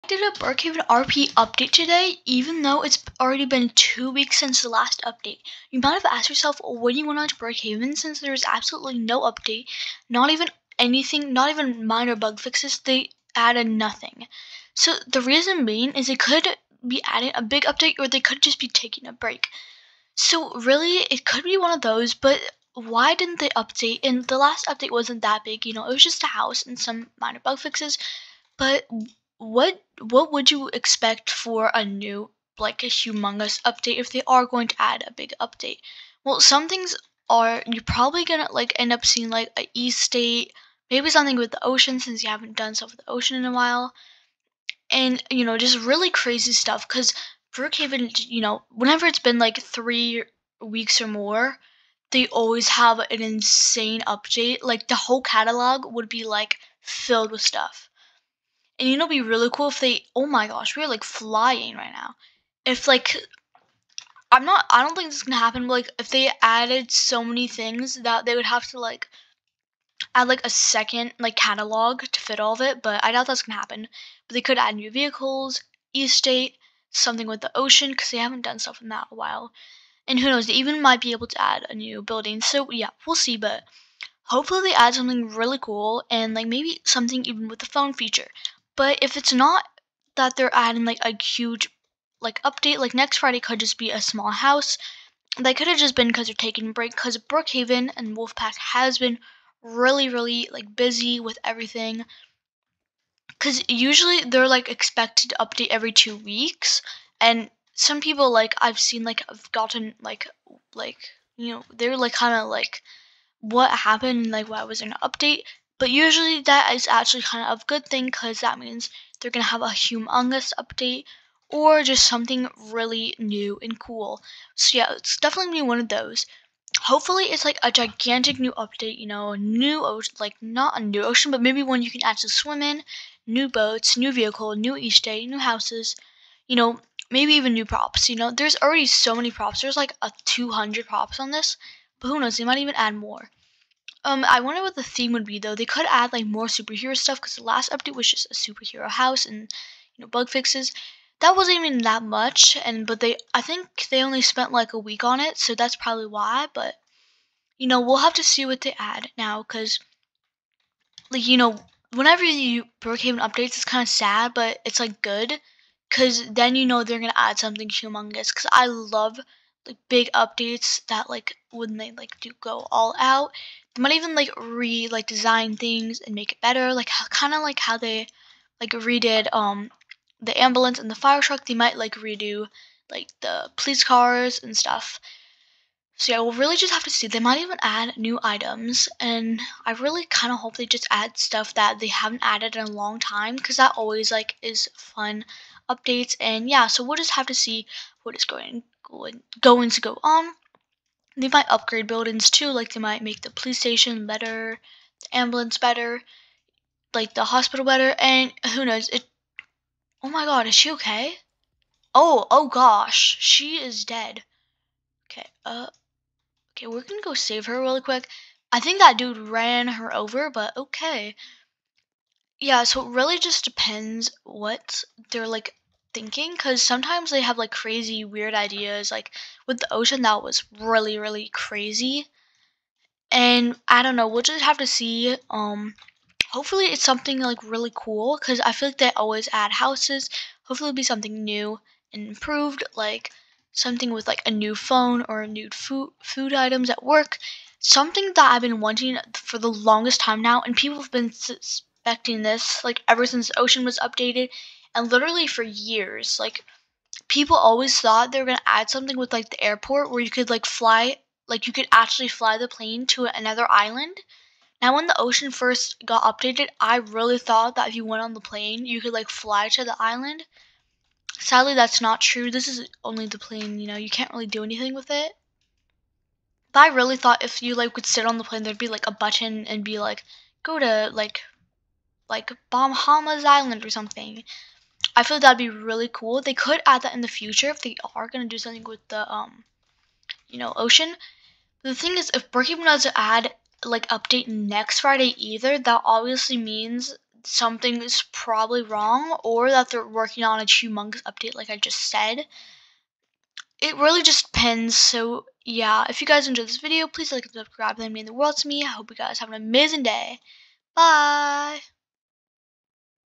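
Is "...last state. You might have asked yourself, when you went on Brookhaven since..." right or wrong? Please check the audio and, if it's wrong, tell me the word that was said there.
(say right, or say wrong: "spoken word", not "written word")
wrong: "update", not "state".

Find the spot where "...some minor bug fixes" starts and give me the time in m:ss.
0:26.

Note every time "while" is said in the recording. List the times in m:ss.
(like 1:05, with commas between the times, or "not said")
0:43, 1:19.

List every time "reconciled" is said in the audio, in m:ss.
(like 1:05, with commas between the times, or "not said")
not said.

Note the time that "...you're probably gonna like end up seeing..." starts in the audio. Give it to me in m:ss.
0:37.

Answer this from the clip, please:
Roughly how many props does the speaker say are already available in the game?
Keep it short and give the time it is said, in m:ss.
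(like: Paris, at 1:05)
200, at 2:20.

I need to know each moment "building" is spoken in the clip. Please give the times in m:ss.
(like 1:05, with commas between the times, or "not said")
1:22, 3:21.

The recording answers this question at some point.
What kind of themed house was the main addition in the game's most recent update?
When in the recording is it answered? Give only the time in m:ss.
2:28.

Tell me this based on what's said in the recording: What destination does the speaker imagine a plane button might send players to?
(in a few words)
Bahamas Island.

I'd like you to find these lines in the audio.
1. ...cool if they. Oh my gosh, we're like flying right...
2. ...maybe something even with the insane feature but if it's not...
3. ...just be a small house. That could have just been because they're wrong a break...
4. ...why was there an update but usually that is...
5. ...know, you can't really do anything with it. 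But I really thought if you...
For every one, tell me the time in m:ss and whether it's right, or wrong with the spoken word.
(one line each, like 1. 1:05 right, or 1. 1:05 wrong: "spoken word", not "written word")
1. 0:59 right
2. 1:26 wrong: "phone", not "insane"
3. 1:33 wrong: "taking", not "wrong"
4. 1:54 right
5. 4:33 right.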